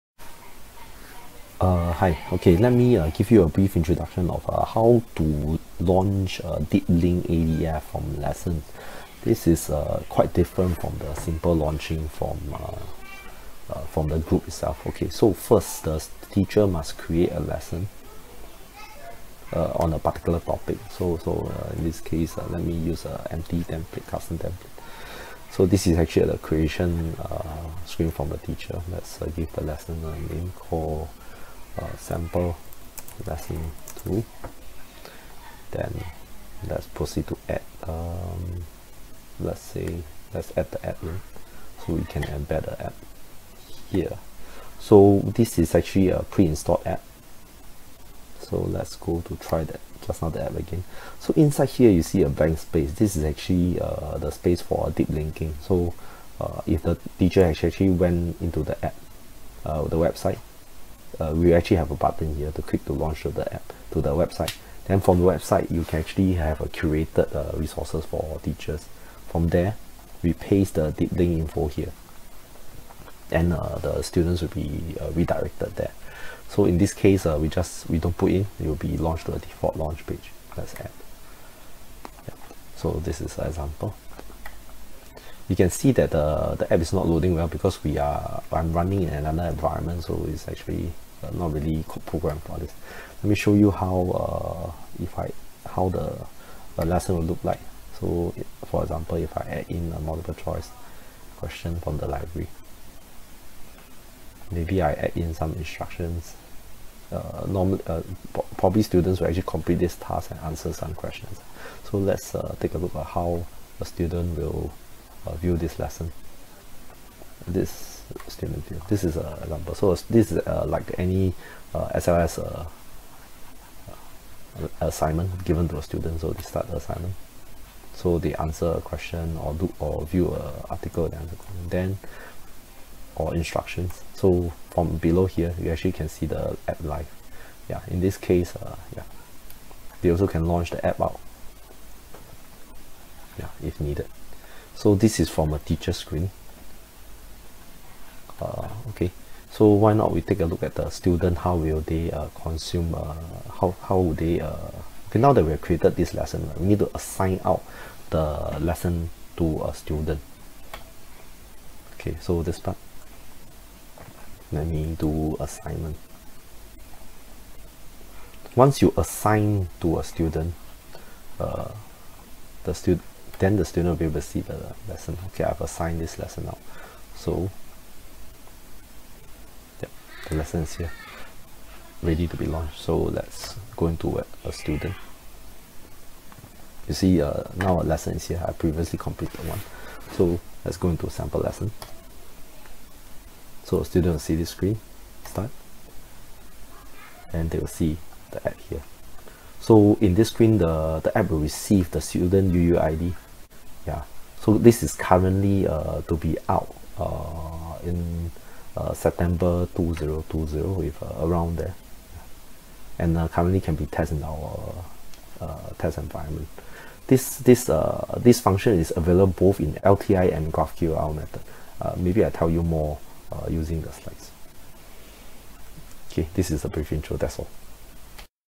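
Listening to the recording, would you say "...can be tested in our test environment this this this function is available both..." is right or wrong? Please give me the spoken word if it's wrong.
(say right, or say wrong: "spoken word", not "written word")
right.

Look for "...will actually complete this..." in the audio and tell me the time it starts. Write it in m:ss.
1:49.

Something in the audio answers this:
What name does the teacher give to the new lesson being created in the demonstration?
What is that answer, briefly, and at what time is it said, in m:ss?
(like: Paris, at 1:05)
sample lesson 2, at 0:31.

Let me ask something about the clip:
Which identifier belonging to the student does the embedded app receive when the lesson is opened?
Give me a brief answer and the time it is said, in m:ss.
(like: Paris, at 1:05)
student UUID, at 3:22.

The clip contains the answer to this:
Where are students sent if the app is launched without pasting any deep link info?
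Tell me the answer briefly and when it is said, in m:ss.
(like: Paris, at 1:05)
default launch page, at 1:19.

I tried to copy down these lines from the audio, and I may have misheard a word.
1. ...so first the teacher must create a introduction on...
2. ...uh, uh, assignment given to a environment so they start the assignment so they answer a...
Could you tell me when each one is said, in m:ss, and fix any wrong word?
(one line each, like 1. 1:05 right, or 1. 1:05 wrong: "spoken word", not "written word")
1. 0:15 wrong: "lesson", not "introduction"
2. 2:02 wrong: "student", not "environment".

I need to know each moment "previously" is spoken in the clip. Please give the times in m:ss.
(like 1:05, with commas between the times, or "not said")
3:08.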